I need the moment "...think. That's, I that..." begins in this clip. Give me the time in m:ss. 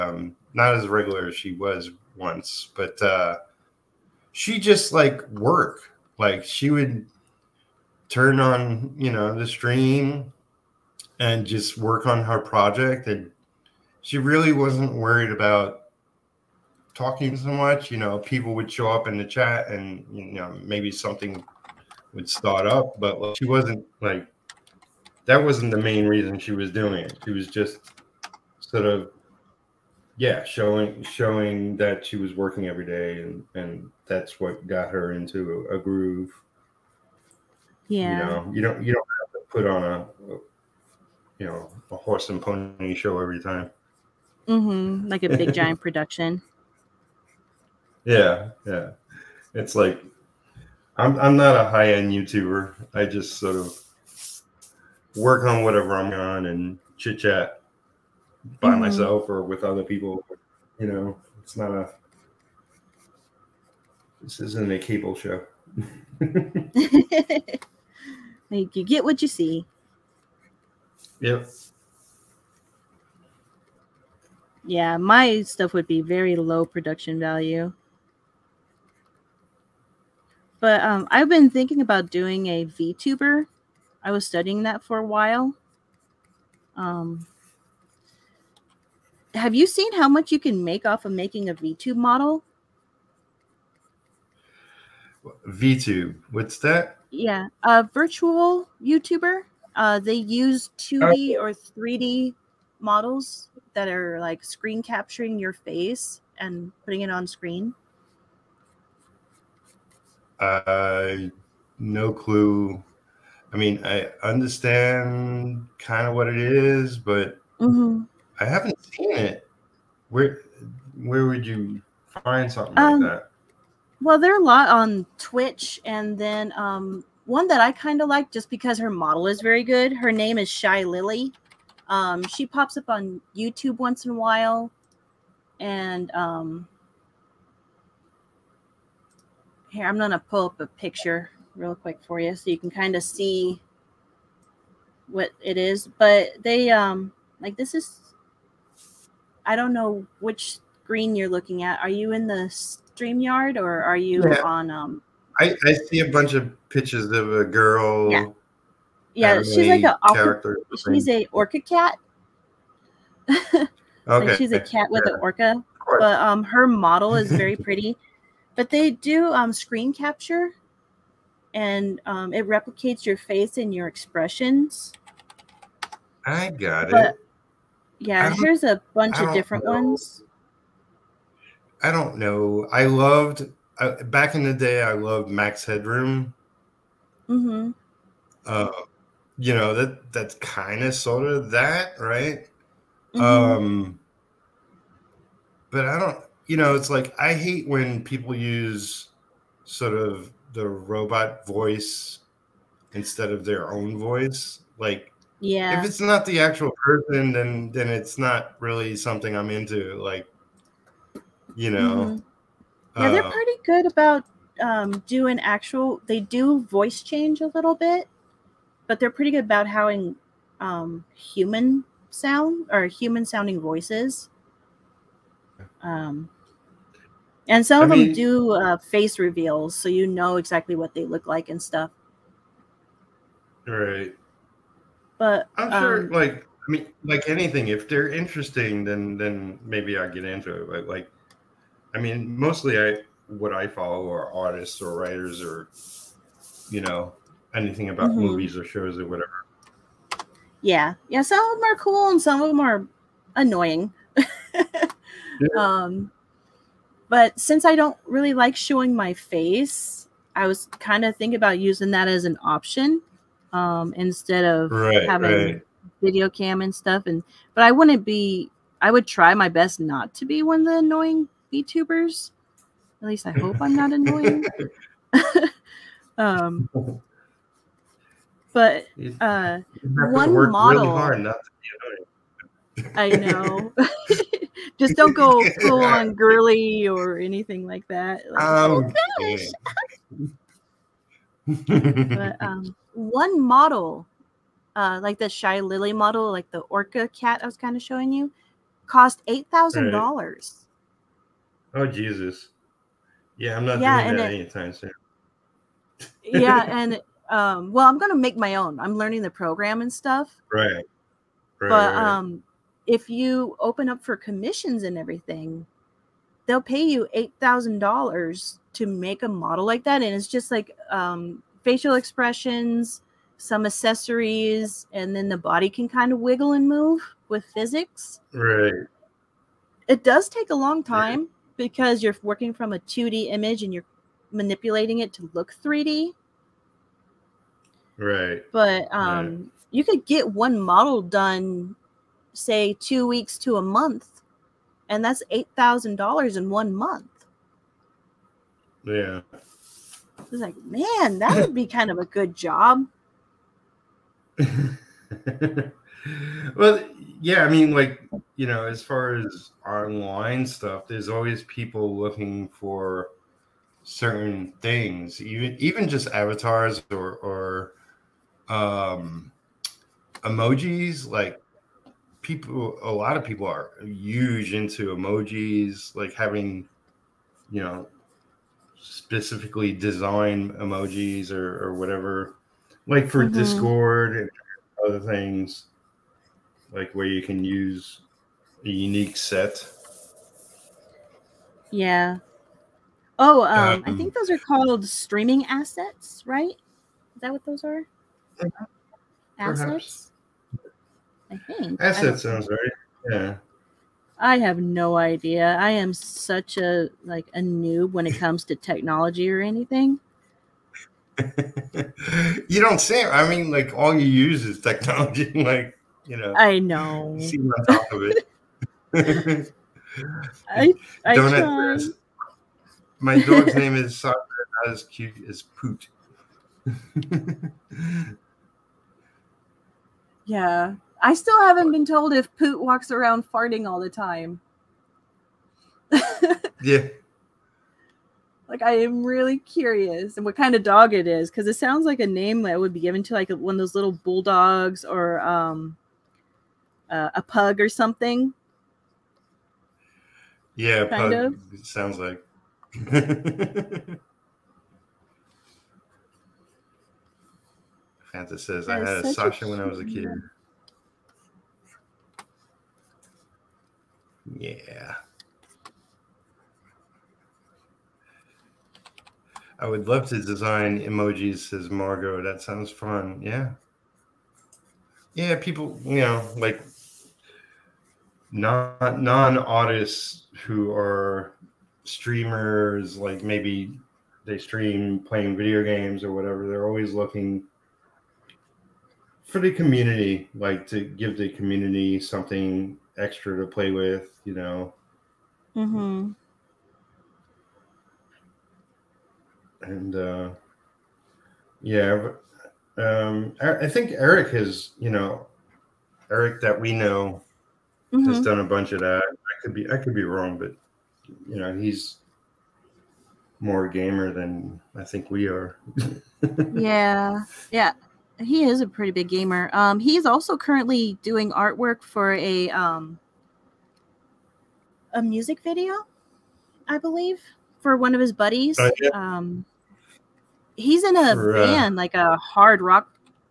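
6:41.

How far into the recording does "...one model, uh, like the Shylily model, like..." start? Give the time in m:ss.
4:52.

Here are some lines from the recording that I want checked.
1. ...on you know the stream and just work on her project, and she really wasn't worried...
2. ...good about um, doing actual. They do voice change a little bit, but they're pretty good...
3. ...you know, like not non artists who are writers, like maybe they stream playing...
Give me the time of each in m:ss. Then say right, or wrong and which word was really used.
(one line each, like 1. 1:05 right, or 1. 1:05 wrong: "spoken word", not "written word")
1. 0:08 right
2. 3:33 right
3. 7:55 wrong: "streamers", not "writers".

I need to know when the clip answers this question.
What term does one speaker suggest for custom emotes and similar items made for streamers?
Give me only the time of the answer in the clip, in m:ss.
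6:34.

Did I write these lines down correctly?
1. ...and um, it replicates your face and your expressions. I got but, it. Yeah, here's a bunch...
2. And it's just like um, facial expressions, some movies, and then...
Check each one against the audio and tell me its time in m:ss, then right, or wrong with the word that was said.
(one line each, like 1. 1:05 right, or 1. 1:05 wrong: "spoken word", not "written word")
1. 2:51 right
2. 5:20 wrong: "accessories", not "movies".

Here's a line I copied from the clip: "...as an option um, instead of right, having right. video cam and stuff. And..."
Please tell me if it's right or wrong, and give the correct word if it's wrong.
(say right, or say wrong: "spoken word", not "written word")
right.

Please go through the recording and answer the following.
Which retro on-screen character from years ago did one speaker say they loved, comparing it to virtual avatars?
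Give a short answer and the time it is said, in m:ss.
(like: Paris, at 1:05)
Max Headroom, at 3:05.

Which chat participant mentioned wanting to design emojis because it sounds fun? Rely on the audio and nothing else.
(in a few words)
Margot.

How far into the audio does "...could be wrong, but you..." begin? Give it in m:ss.
8:29.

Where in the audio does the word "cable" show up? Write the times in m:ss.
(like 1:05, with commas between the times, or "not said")
1:04.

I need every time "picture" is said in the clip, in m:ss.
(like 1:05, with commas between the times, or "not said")
2:20, 2:36.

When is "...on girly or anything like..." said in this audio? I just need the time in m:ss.
4:45.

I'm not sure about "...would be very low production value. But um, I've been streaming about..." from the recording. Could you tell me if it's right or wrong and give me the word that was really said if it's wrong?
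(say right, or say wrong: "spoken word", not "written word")
wrong: "thinking", not "streaming".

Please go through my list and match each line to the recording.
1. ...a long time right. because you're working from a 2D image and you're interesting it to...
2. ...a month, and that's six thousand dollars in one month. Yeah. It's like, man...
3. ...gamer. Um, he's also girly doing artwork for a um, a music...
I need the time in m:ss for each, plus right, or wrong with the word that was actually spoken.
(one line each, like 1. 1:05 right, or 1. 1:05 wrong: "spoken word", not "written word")
1. 5:30 wrong: "manipulating", not "interesting"
2. 5:43 wrong: "eight", not "six"
3. 8:39 wrong: "currently", not "girly".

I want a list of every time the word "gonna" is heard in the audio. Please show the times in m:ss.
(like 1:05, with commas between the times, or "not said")
2:19, 5:07.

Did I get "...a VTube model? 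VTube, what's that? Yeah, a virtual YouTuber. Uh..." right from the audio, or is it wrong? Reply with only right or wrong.
right.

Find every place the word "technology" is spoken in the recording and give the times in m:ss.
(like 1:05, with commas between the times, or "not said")
6:48, 6:54.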